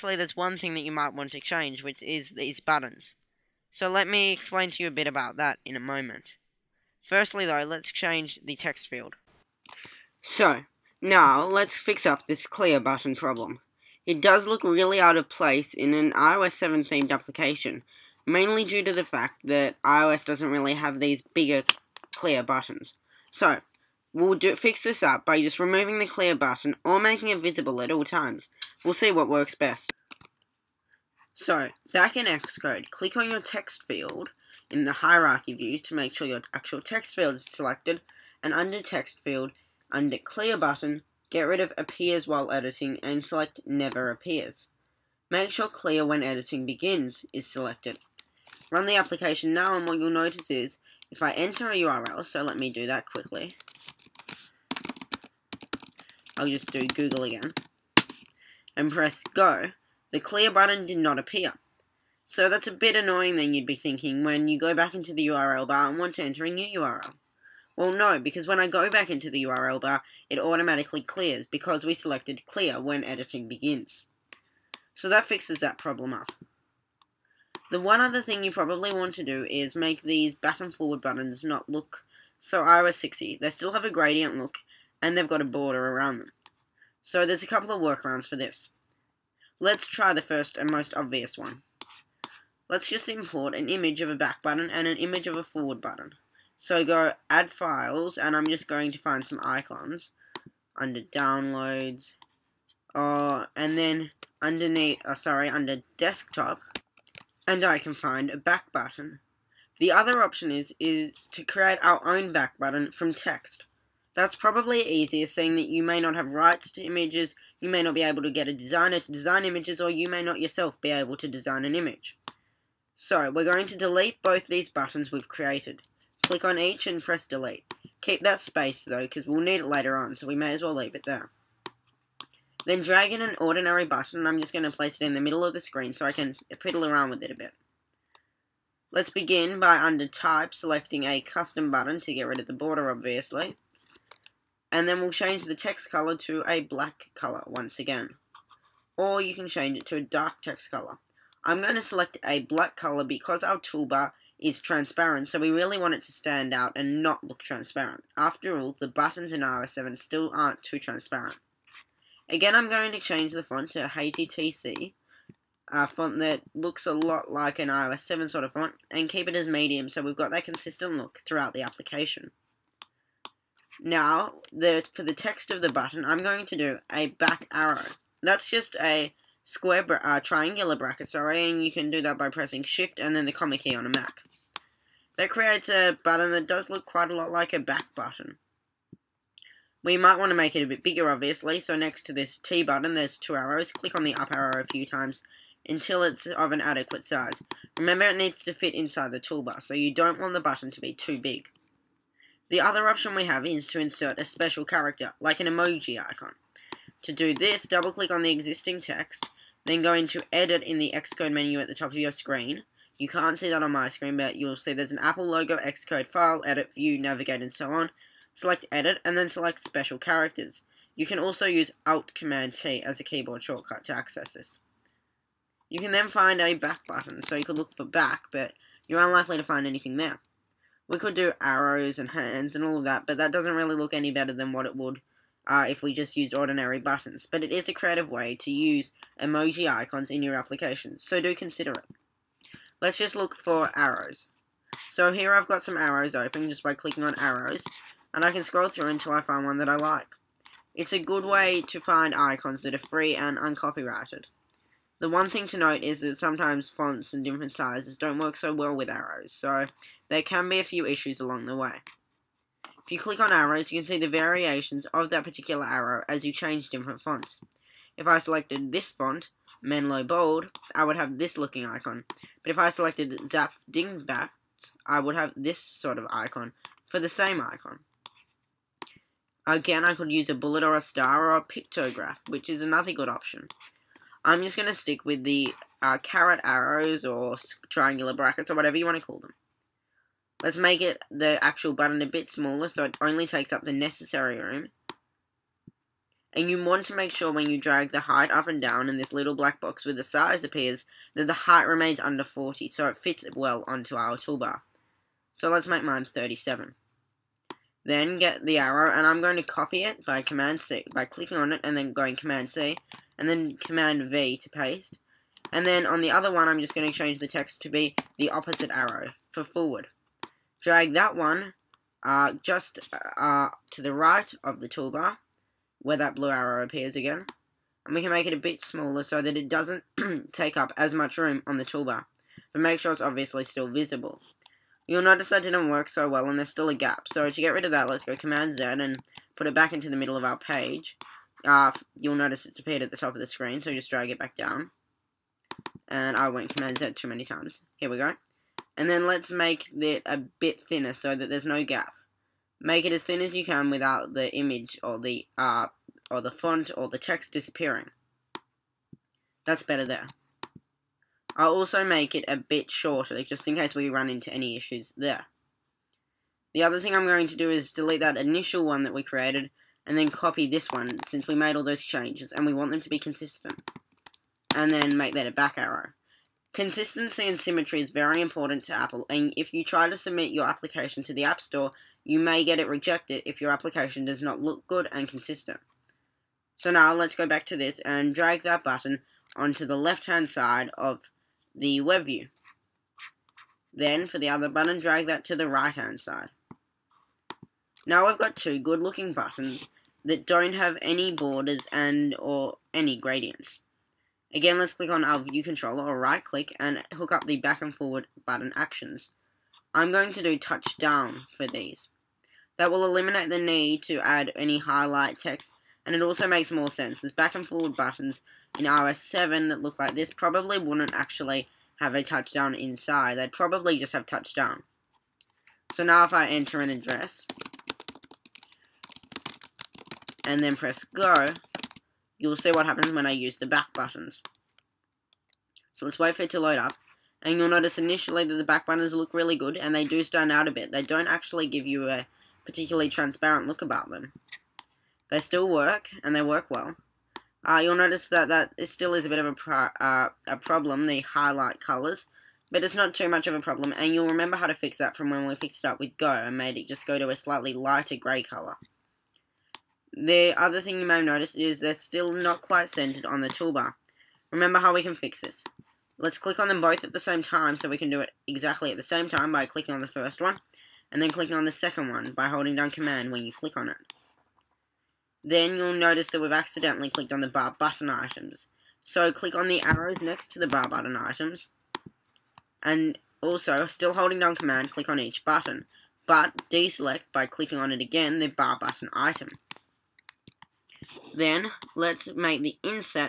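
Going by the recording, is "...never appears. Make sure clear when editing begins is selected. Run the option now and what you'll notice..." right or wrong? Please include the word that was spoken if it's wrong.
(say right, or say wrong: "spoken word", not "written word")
wrong: "application", not "option".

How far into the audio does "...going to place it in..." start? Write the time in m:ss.
2:14.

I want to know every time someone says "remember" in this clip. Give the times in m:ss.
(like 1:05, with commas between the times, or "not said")
3:17, 7:34, 7:44.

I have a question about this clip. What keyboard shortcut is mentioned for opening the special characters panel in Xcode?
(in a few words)
Alt Command T.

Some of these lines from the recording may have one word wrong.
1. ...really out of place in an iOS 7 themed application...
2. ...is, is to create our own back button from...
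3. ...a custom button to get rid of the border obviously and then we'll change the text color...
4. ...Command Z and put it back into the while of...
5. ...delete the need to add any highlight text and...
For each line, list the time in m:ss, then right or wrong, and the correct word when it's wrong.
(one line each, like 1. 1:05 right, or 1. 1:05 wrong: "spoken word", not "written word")
1. 0:14 right
2. 1:50 right
3. 2:21 right
4. 5:38 wrong: "middle", not "while"
5. 6:52 wrong: "eliminate", not "delete".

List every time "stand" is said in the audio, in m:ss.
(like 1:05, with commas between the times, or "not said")
2:36, 7:20.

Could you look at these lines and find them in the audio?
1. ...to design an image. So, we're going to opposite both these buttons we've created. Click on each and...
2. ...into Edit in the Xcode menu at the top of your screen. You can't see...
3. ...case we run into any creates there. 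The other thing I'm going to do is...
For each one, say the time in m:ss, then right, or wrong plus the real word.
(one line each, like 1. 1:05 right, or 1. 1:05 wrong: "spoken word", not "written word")
1. 2:01 wrong: "delete", not "opposite"
2. 3:29 right
3. 6:03 wrong: "issues", not "creates".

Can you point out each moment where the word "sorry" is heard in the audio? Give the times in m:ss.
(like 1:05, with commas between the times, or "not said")
1:45, 3:01.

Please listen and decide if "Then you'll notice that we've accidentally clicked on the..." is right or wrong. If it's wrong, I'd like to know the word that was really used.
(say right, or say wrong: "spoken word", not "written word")
right.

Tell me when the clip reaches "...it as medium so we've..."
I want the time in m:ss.
2:49.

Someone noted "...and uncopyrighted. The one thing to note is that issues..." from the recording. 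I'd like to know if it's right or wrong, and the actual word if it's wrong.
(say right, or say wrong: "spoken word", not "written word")
wrong: "sometimes", not "issues".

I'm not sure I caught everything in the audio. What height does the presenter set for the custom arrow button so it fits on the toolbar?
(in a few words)
37.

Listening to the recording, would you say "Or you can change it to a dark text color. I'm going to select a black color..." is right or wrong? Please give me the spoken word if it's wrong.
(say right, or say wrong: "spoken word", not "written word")
right.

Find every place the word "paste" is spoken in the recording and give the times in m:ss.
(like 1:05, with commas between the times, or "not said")
5:14.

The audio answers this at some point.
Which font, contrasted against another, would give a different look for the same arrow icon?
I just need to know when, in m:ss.
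4:33.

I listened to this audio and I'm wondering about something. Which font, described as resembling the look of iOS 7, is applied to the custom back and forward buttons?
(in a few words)
Heiti TC.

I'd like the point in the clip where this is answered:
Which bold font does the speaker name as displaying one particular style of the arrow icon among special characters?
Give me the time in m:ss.
4:29.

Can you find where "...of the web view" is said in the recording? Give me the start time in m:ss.
6:30.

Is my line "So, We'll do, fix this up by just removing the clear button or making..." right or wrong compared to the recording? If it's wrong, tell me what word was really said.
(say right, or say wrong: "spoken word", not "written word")
right.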